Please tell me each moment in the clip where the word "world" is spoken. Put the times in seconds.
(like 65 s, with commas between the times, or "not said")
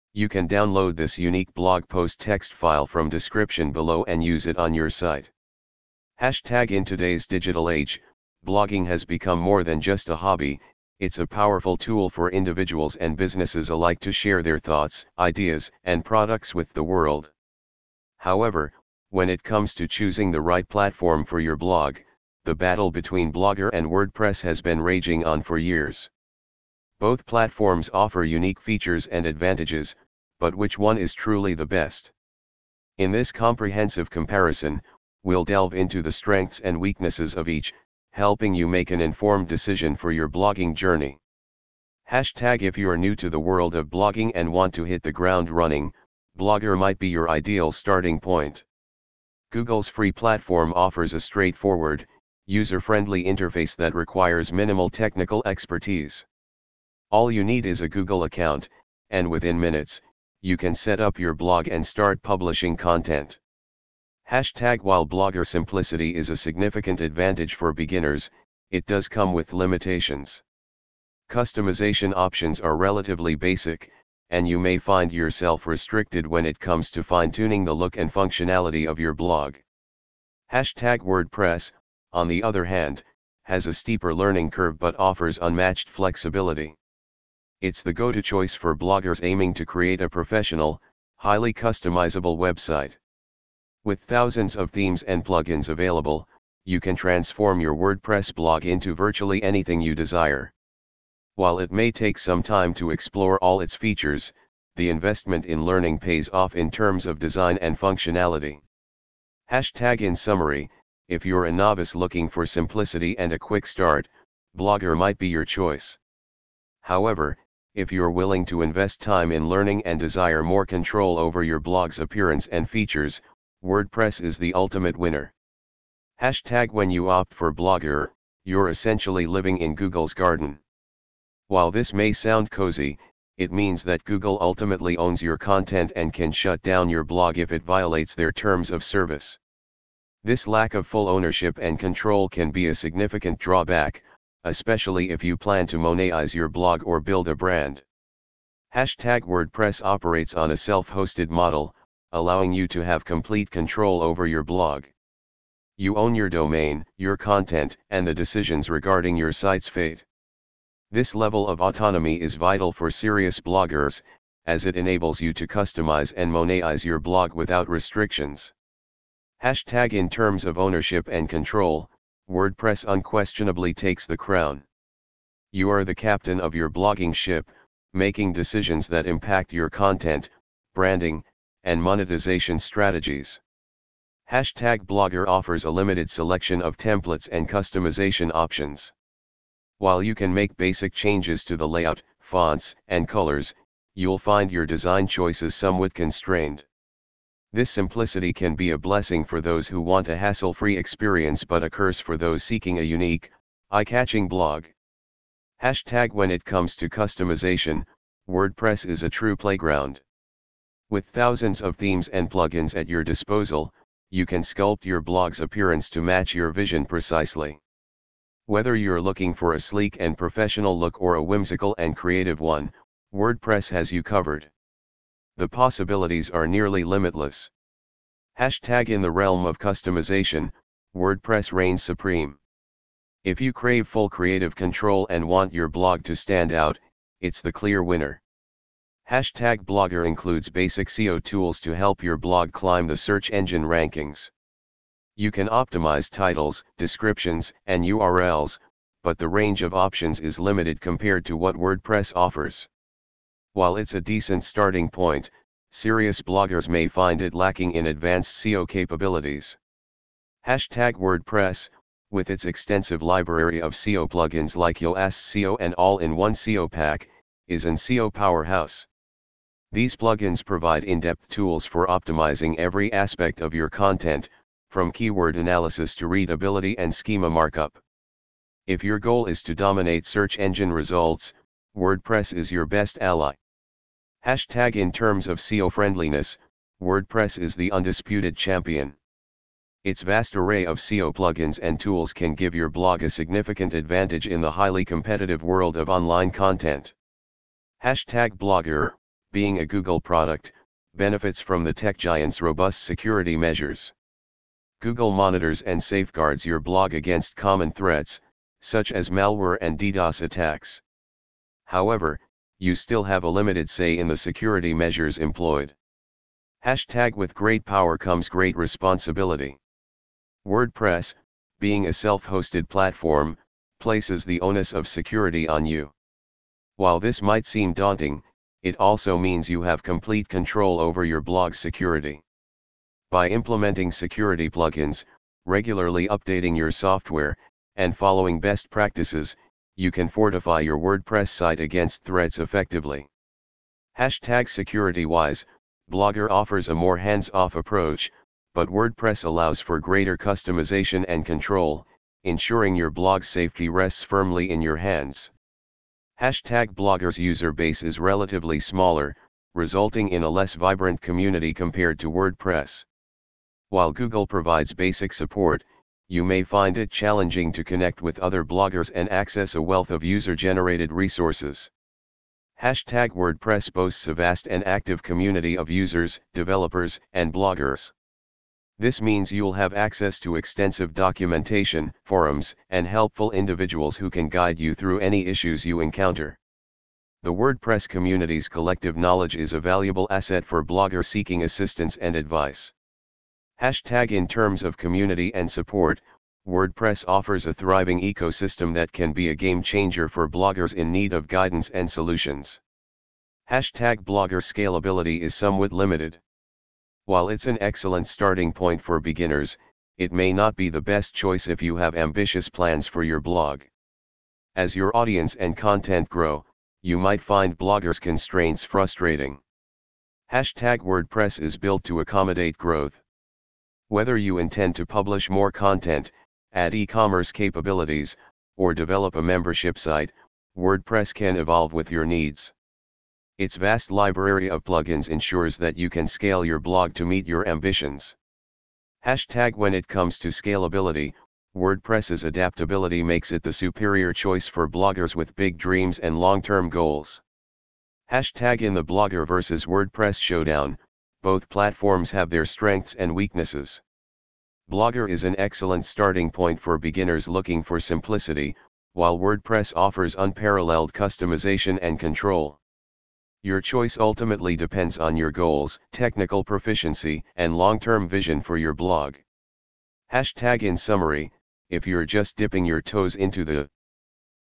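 16 s, 43 s, 295 s.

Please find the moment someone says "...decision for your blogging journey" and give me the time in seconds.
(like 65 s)
39 s.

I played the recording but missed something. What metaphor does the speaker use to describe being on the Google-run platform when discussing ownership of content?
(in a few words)
Google's garden.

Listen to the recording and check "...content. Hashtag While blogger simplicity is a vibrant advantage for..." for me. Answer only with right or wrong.
wrong.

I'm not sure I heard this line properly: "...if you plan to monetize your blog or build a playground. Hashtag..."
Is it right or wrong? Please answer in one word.
wrong.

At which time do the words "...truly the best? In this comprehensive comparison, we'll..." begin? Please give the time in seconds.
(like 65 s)
31 s.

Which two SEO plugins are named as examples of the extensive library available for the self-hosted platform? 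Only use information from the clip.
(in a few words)
Yoast SEO and All-in-One SEO Pack.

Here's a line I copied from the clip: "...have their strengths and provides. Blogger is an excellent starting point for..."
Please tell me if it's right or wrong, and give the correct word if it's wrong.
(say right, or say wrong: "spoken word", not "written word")
wrong: "weaknesses", not "provides".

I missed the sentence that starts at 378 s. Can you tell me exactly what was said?
This means you'll have access to extensive documentation, forums, and helpful individuals who can guide you through any issues you encounter.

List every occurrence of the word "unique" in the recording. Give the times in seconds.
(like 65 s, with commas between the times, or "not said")
1 s, 28 s, 202 s.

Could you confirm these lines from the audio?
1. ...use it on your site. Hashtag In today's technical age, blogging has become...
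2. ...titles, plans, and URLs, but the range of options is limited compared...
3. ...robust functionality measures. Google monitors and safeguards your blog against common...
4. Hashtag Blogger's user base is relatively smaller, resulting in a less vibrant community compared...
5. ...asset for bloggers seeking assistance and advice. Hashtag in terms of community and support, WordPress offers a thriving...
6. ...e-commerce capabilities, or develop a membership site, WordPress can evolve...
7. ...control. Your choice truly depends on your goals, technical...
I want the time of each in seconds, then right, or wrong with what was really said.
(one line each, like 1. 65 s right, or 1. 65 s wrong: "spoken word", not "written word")
1. 4 s wrong: "digital", not "technical"
2. 246 s wrong: "descriptions", not "plans"
3. 302 s wrong: "security", not "functionality"
4. 356 s right
5. 390 s right
6. 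426 s right
7. 461 s wrong: "ultimately", not "truly".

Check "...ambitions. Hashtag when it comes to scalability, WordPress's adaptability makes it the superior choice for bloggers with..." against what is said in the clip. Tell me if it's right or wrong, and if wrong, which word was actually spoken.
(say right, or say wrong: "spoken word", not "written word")
right.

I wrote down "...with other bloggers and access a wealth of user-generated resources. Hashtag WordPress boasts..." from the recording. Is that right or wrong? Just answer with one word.
right.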